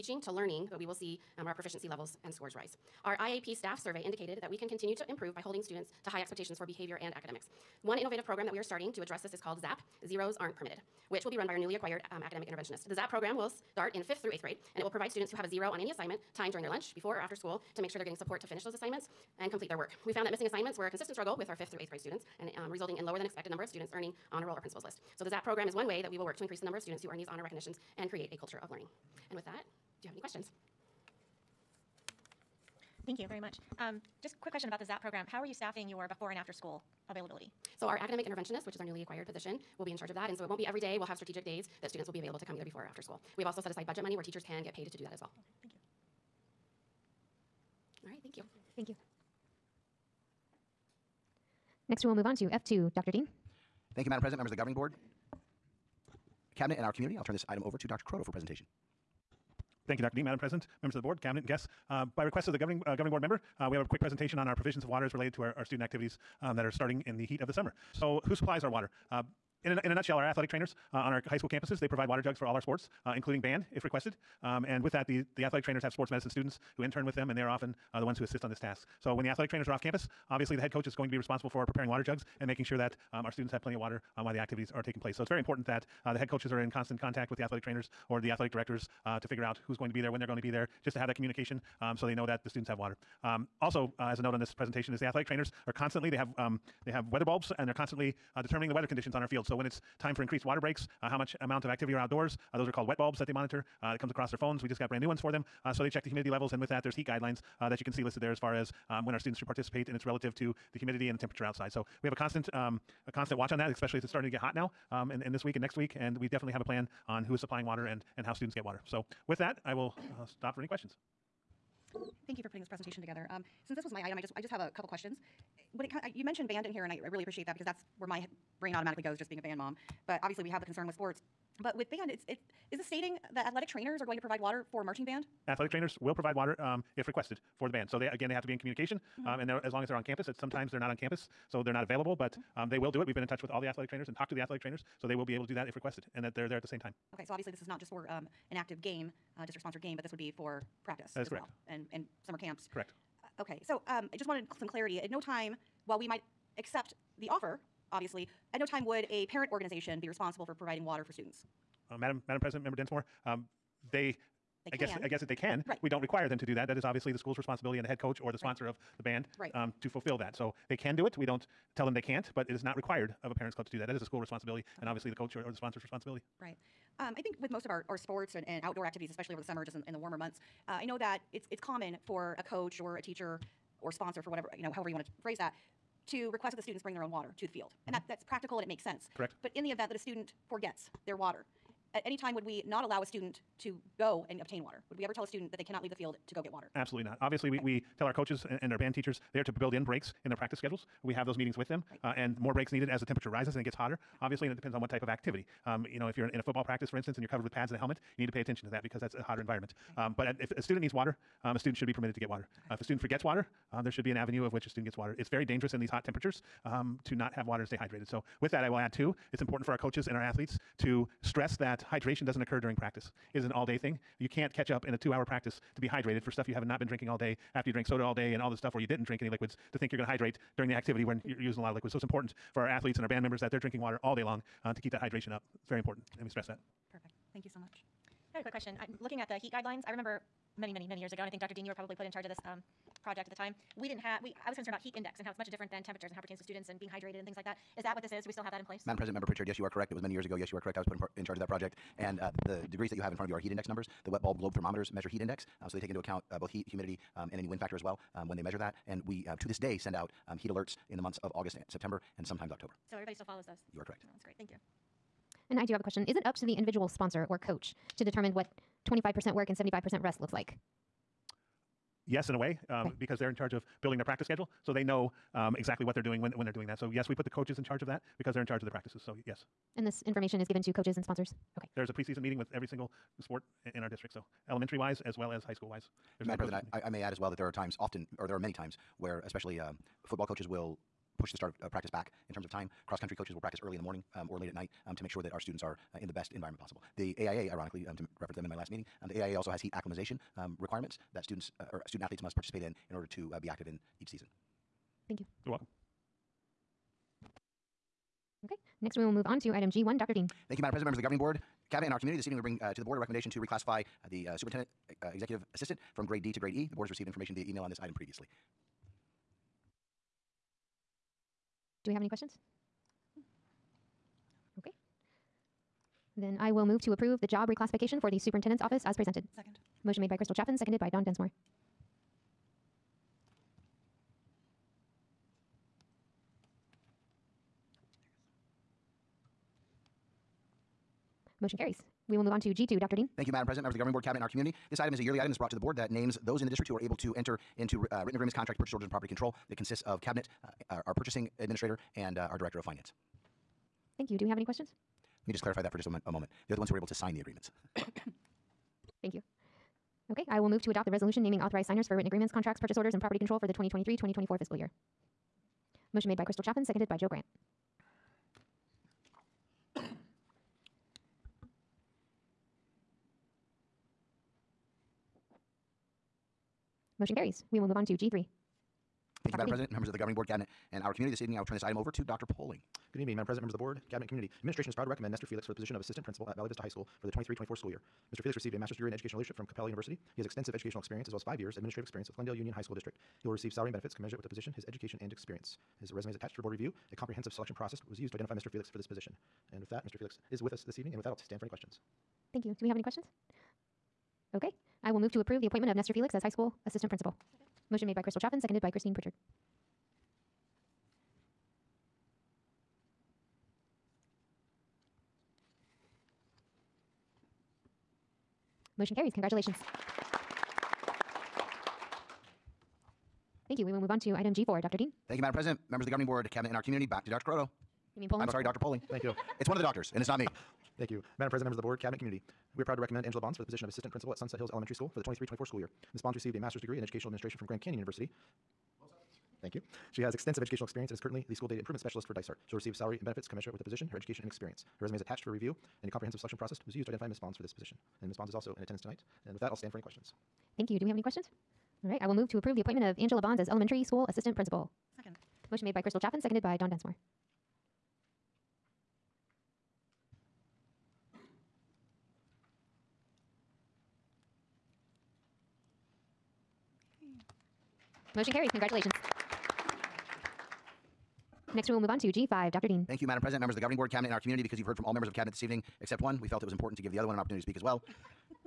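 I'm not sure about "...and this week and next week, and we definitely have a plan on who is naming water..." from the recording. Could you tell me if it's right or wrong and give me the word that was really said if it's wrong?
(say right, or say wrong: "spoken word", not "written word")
wrong: "supplying", not "naming".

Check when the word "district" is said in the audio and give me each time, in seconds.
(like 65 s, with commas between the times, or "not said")
149 s, 283 s, 346 s, 392 s.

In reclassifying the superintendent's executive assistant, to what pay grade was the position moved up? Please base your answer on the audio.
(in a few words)
grade E.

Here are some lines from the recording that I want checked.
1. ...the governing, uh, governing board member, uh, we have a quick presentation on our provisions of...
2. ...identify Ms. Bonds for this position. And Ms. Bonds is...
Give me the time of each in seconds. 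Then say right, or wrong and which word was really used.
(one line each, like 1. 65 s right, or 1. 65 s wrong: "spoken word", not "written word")
1. 62 s right
2. 446 s right.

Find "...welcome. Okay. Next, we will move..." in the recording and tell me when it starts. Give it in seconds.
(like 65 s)
305 s.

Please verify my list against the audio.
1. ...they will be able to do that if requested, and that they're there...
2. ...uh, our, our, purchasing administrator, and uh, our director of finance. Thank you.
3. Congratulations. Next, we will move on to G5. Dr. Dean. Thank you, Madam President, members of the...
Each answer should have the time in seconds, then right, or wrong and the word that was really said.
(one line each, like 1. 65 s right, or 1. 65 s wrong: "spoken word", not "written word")
1. 145 s right
2. 350 s right
3. 468 s right.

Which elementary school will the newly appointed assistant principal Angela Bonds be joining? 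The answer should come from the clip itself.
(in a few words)
Sunset Hills Elementary School.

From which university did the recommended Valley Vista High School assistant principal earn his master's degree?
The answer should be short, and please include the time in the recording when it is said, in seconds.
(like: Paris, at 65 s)
Capella University, at 389 s.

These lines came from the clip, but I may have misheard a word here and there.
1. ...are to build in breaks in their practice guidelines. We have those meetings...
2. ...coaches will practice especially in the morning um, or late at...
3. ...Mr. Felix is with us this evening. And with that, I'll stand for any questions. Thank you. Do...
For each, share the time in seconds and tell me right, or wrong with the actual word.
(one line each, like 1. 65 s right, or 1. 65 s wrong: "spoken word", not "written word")
1. 199 s wrong: "schedules", not "guidelines"
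2. 293 s wrong: "early", not "especially"
3. 399 s right.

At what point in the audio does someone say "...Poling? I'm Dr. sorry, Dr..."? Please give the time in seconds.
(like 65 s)
428 s.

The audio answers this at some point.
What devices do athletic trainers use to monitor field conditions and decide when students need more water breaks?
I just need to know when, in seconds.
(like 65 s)
102 s.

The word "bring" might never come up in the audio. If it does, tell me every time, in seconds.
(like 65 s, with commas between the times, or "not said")
186 s, 312 s.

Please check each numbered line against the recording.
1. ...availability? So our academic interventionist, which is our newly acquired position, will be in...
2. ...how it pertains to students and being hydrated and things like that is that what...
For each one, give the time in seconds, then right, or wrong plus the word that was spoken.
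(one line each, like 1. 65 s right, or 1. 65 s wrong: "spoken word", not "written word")
1. 37 s right
2. 246 s right.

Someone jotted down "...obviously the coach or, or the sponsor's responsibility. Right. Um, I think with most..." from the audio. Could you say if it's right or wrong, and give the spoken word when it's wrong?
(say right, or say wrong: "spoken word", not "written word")
right.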